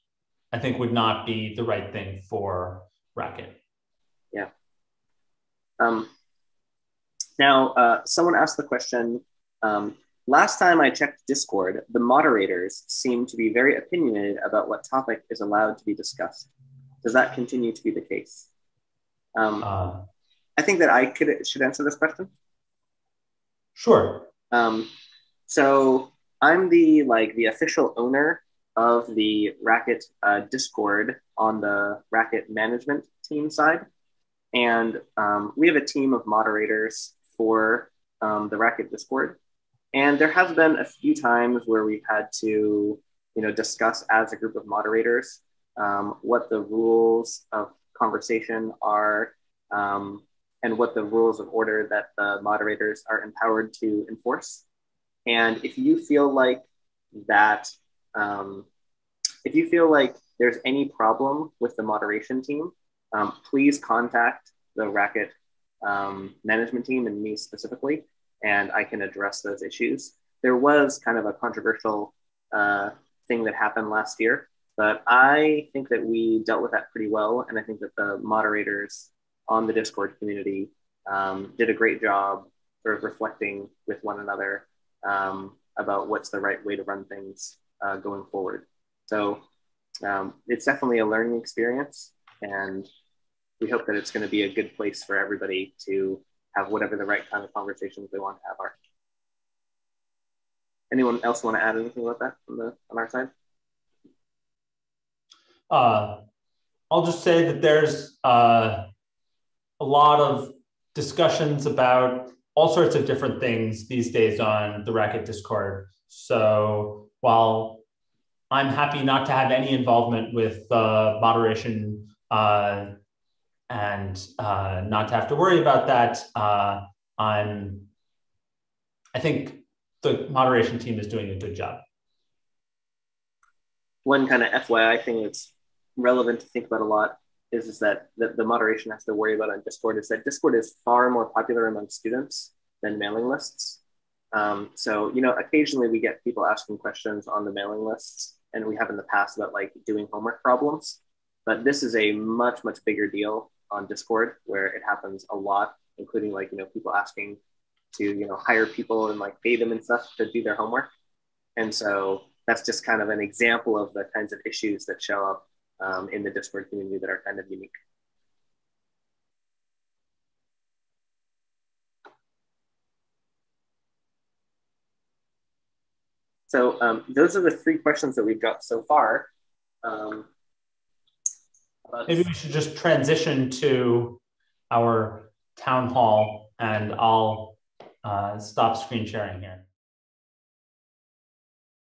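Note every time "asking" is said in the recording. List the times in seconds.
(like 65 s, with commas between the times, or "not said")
146 s, 156 s.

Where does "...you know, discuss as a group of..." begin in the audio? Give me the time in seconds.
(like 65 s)
42 s.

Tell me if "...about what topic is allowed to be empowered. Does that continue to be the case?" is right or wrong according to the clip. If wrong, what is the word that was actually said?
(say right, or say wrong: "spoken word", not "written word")
wrong: "discussed", not "empowered".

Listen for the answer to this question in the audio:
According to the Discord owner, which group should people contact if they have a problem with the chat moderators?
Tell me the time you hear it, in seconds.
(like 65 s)
64 s.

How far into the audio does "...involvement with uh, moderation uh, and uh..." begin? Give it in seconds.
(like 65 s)
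119 s.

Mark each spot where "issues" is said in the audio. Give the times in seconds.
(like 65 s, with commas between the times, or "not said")
69 s, 164 s.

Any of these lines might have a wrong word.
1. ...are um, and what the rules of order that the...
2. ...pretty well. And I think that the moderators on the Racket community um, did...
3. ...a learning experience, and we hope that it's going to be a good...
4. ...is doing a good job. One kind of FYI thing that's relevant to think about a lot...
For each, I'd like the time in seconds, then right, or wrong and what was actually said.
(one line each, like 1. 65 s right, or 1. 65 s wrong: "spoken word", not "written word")
1. 48 s right
2. 76 s wrong: "Discord", not "Racket"
3. 90 s right
4. 130 s right.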